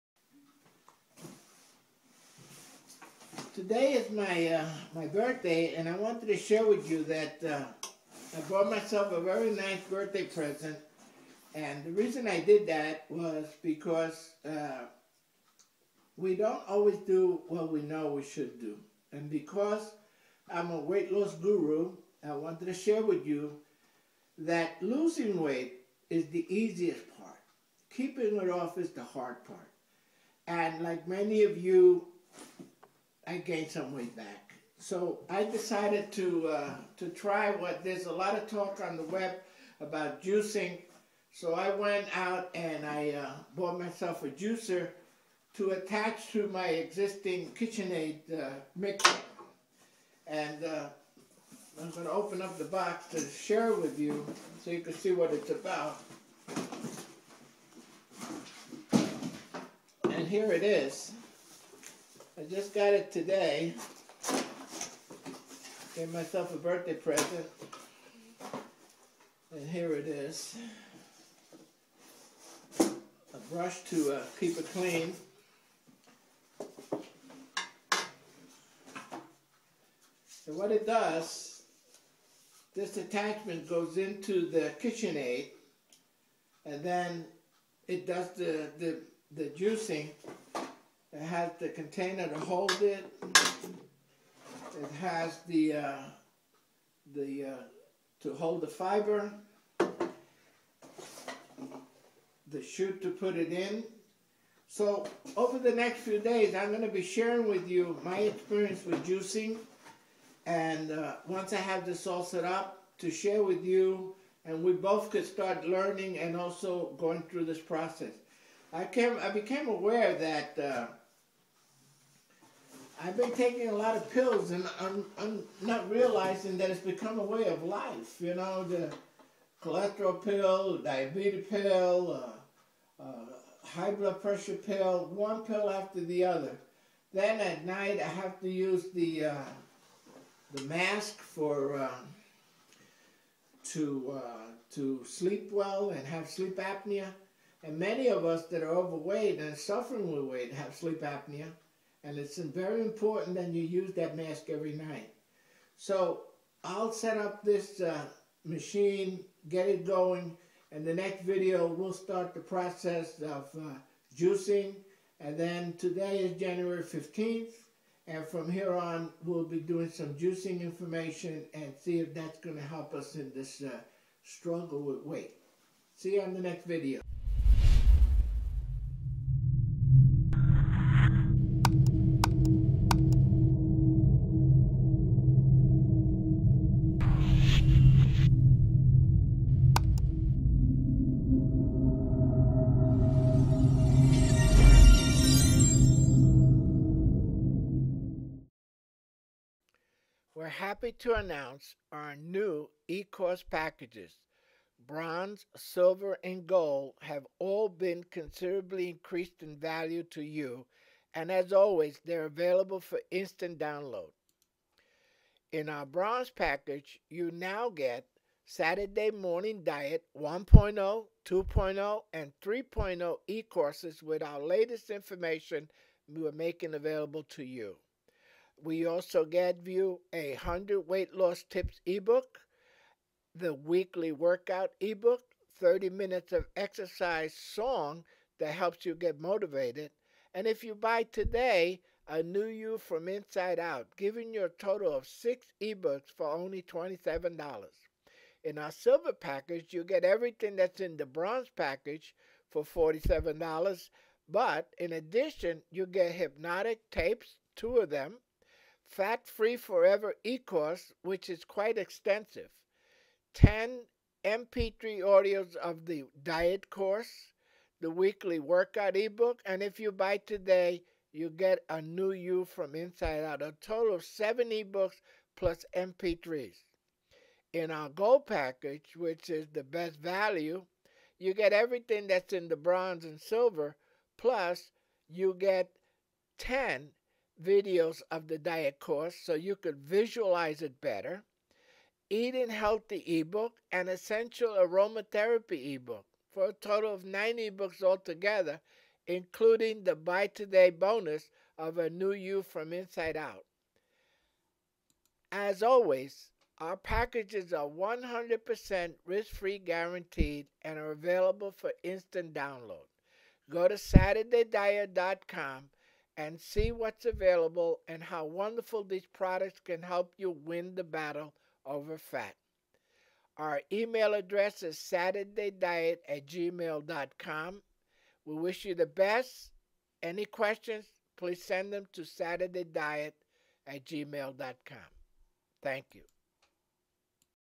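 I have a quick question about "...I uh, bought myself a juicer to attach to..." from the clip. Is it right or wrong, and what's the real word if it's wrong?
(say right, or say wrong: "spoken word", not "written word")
right.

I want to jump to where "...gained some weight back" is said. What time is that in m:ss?
0:33.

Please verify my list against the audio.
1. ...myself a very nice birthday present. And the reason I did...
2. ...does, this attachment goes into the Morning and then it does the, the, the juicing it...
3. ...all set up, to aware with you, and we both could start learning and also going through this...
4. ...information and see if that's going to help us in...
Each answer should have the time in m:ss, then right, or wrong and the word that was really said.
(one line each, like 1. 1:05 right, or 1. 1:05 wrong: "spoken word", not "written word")
1. 0:08 right
2. 1:20 wrong: "KitchenAid", not "Morning"
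3. 1:52 wrong: "share", not "aware"
4. 2:50 right.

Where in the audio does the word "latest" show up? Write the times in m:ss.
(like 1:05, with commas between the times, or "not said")
3:44.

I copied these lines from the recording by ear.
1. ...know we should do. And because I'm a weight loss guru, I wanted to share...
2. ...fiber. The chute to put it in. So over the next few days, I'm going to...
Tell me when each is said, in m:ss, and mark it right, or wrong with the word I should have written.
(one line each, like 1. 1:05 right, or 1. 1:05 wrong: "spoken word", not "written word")
1. 0:17 right
2. 1:38 right.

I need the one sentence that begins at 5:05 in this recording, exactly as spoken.
As always, our packages are 100% risk free guaranteed and are available for instant download.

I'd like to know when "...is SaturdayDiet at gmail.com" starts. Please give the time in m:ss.
5:24.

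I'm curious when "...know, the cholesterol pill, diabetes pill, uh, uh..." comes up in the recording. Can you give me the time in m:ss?
2:08.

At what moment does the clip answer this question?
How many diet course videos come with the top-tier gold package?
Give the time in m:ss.
4:46.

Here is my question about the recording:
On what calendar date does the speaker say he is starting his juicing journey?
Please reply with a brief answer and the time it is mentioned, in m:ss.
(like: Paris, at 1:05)
January 15th, at 2:46.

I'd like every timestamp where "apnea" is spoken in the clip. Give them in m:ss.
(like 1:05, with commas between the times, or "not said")
2:26, 2:31.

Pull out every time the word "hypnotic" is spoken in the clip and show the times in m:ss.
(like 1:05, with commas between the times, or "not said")
4:16.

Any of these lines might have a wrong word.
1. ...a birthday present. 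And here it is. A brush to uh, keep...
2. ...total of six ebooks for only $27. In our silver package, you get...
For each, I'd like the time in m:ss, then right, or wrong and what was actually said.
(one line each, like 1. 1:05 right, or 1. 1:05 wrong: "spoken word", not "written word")
1. 1:06 right
2. 4:04 right.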